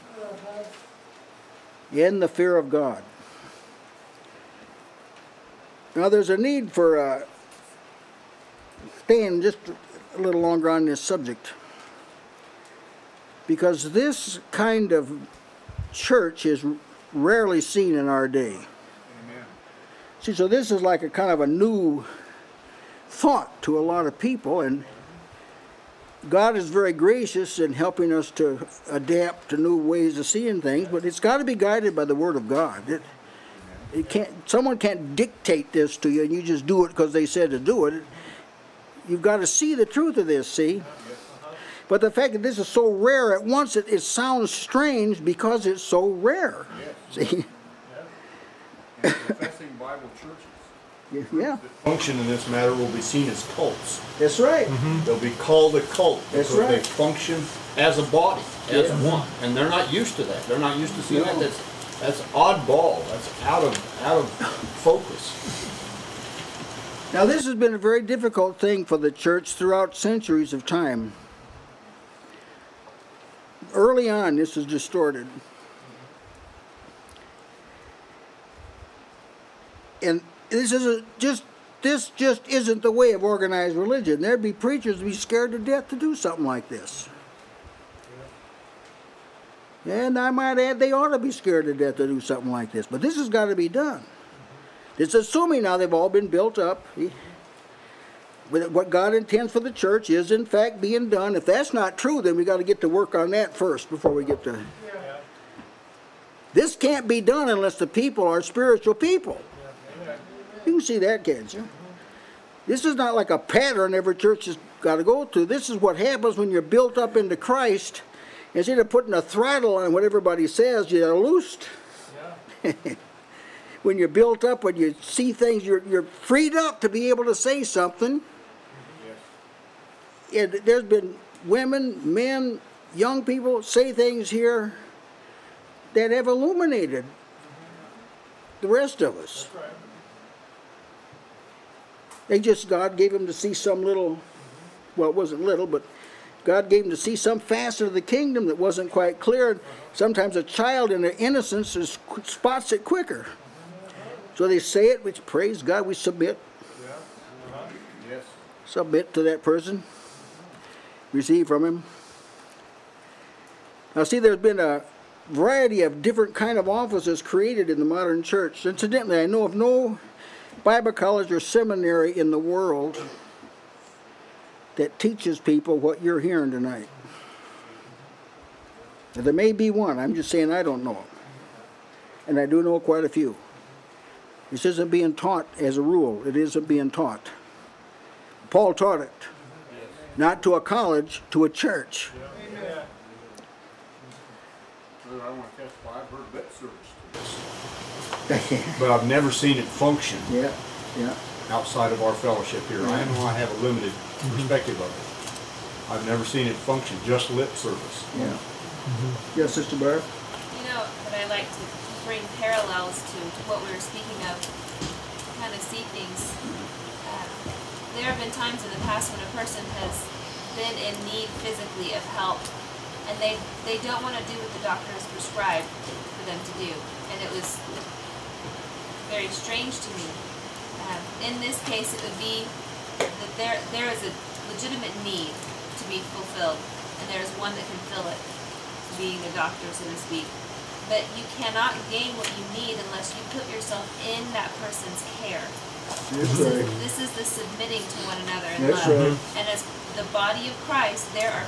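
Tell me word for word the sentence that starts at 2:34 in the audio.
So they say it, which praise God, we submit.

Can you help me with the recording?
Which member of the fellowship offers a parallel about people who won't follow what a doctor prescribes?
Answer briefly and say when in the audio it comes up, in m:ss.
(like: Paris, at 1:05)
Sister Barb, at 3:29.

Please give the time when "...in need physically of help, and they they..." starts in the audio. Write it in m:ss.
3:40.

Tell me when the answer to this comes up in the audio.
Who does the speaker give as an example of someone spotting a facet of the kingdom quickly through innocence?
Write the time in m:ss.
2:30.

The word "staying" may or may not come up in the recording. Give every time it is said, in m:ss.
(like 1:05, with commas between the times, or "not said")
0:09.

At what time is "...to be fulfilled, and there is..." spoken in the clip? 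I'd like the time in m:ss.
3:55.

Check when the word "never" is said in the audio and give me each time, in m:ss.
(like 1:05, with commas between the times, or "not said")
3:19, 3:26.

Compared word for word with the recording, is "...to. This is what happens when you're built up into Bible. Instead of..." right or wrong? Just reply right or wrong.
wrong.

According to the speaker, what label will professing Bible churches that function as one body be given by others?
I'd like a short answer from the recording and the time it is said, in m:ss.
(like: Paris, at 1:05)
Cults, at 0:53.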